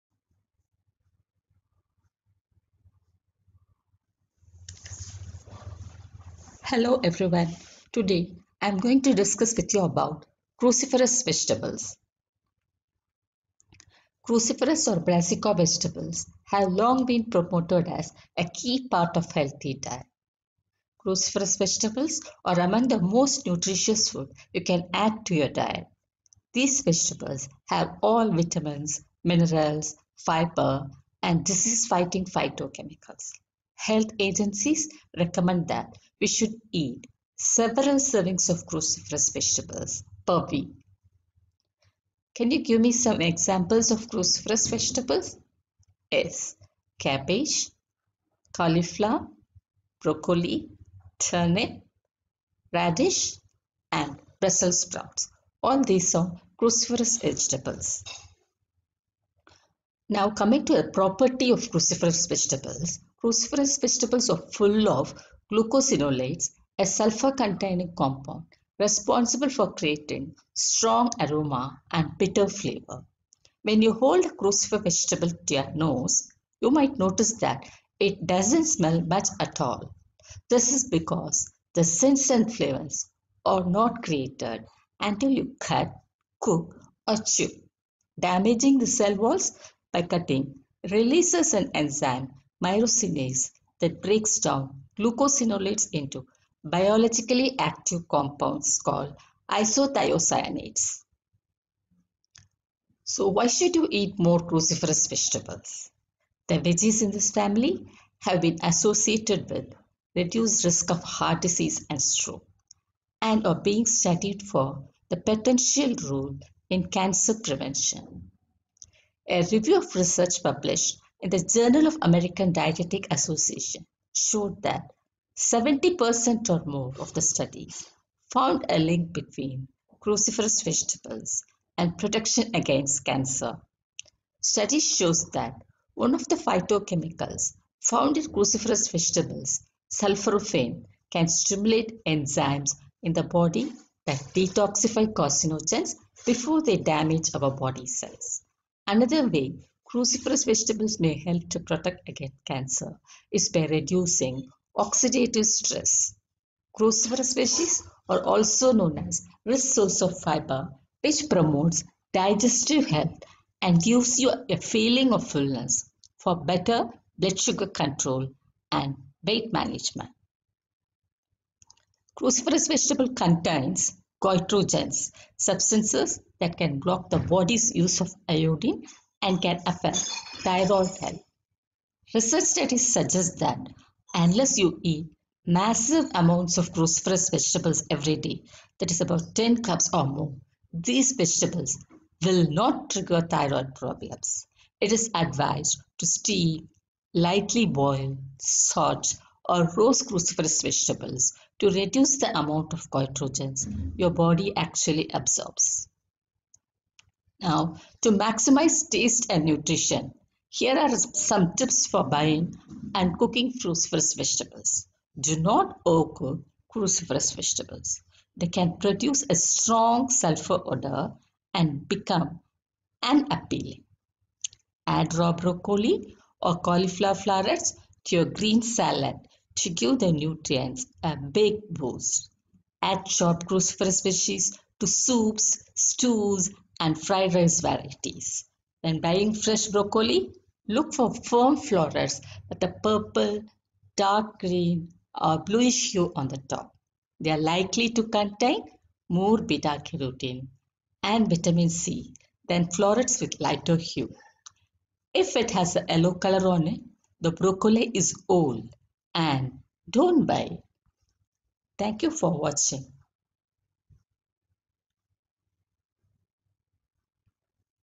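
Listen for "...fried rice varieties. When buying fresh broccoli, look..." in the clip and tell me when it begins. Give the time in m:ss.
3:57.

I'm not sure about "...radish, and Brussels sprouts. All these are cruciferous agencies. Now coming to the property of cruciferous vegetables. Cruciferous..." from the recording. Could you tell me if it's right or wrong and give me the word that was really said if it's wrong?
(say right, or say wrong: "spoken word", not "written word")
wrong: "vegetables", not "agencies".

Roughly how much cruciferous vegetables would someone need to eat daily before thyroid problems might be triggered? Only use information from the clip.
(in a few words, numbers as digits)
10 cups or more.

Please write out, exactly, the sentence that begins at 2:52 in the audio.
Cruciferous vegetable contains goitrogens, substances that can block the body's use of iodine and can affect thyroid health.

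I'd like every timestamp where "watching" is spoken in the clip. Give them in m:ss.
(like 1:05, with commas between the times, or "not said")
4:22.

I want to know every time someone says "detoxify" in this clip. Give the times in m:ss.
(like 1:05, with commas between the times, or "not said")
2:24.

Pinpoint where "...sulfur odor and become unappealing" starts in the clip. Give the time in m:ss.
3:40.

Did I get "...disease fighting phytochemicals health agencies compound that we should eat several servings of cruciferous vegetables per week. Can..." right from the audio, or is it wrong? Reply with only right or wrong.
wrong.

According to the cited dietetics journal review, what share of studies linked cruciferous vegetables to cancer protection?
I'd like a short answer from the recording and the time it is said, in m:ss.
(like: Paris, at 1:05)
70% or more, at 2:05.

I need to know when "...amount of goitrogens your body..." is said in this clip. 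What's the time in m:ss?
3:22.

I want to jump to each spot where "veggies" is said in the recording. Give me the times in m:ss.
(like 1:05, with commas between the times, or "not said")
1:46, 2:37, 3:54.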